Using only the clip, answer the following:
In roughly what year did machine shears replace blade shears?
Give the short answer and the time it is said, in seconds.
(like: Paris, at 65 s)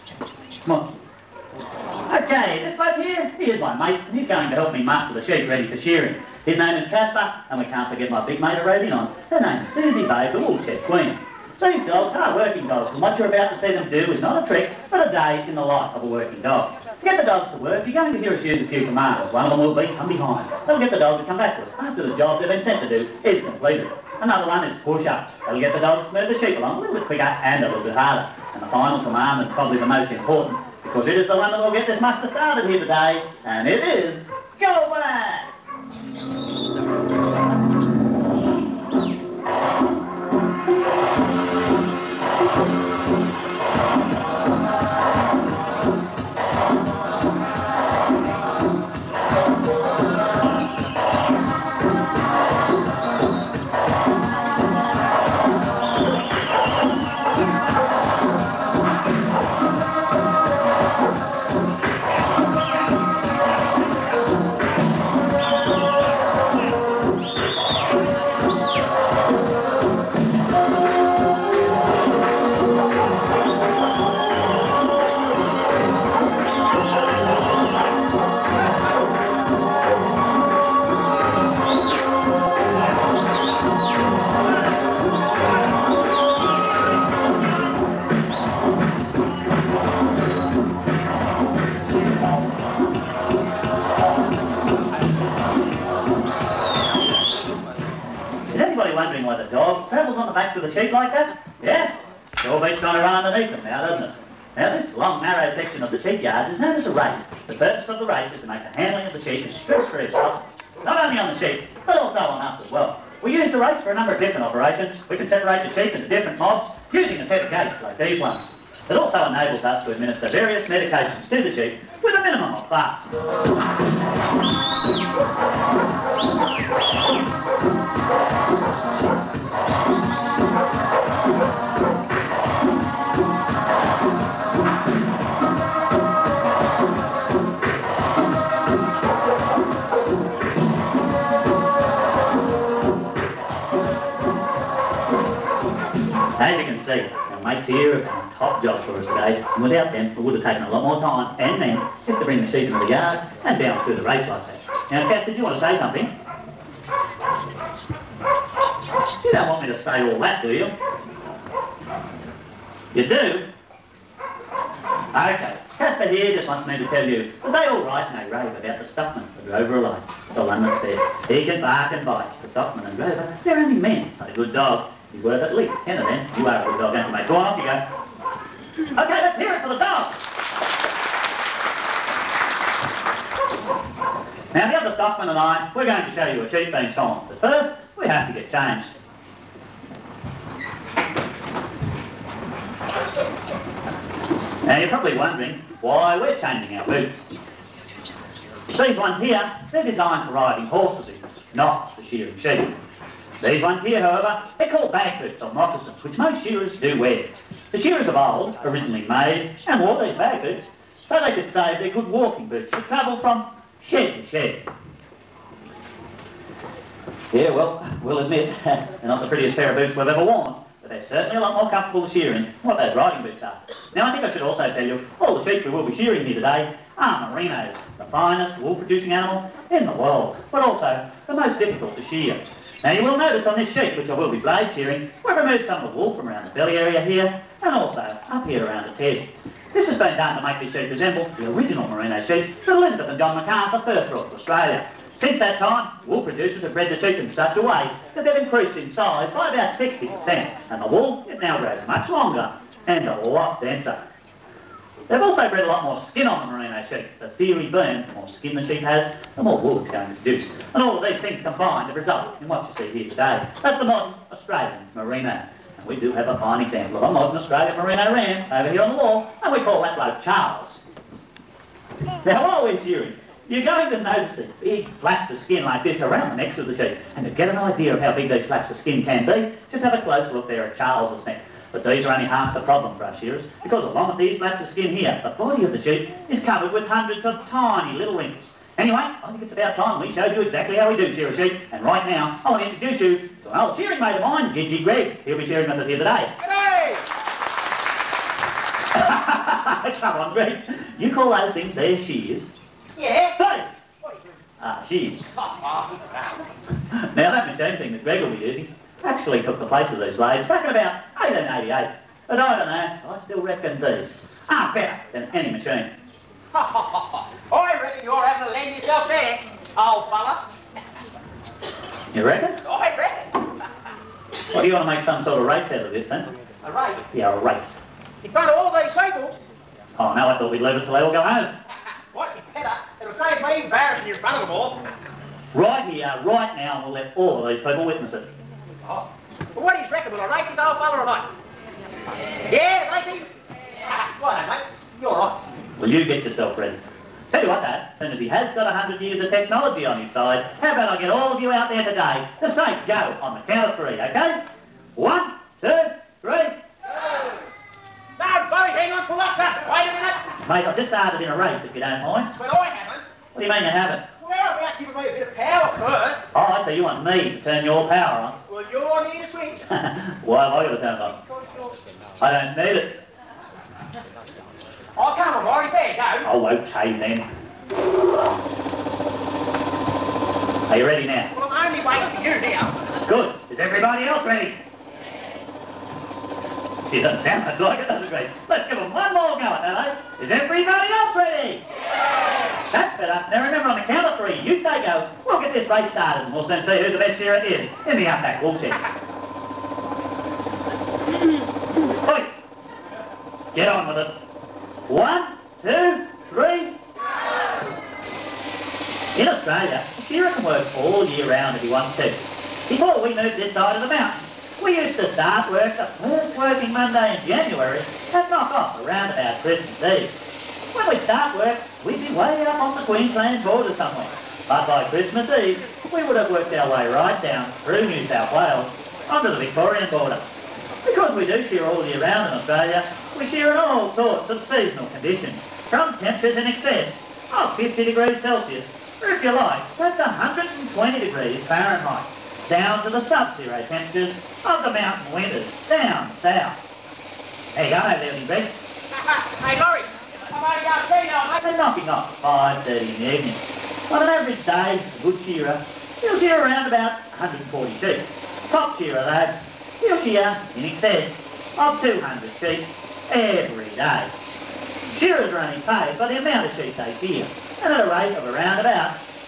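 1888, at 311 s.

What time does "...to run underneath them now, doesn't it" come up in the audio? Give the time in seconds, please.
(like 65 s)
102 s.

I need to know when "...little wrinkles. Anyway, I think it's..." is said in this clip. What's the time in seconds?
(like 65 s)
287 s.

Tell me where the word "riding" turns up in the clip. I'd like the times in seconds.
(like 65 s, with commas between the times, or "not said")
200 s, 222 s.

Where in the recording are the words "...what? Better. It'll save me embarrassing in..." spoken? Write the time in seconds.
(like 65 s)
332 s.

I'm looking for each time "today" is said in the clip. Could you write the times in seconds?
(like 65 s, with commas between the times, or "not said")
32 s, 149 s, 226 s, 263 s, 295 s, 351 s.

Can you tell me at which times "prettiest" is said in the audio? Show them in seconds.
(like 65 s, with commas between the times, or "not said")
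219 s.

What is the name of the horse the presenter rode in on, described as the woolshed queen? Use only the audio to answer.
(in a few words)
Susie Babe.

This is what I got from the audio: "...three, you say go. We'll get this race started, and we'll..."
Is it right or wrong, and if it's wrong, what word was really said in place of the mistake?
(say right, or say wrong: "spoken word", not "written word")
right.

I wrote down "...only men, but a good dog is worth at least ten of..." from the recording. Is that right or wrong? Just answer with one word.
right.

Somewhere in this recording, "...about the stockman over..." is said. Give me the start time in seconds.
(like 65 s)
168 s.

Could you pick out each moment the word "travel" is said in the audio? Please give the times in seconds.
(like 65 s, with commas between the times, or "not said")
212 s.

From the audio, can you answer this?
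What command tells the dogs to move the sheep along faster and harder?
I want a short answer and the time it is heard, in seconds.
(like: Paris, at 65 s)
push-ups, at 24 s.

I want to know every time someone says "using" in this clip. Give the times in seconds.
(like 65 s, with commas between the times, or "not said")
116 s, 308 s.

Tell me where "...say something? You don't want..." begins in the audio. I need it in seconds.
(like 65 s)
155 s.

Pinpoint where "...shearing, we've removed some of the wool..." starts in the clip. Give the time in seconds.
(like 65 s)
234 s.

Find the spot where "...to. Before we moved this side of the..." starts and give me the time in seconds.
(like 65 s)
411 s.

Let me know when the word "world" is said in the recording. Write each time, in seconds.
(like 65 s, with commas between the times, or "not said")
229 s.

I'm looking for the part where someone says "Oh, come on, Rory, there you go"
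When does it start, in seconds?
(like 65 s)
374 s.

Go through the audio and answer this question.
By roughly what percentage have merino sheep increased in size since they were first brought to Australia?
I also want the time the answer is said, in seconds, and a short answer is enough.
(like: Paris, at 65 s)
60%, at 249 s.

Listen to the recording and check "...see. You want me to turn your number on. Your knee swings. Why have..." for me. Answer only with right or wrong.
wrong.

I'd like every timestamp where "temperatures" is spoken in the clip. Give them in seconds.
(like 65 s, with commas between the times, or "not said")
435 s, 443 s.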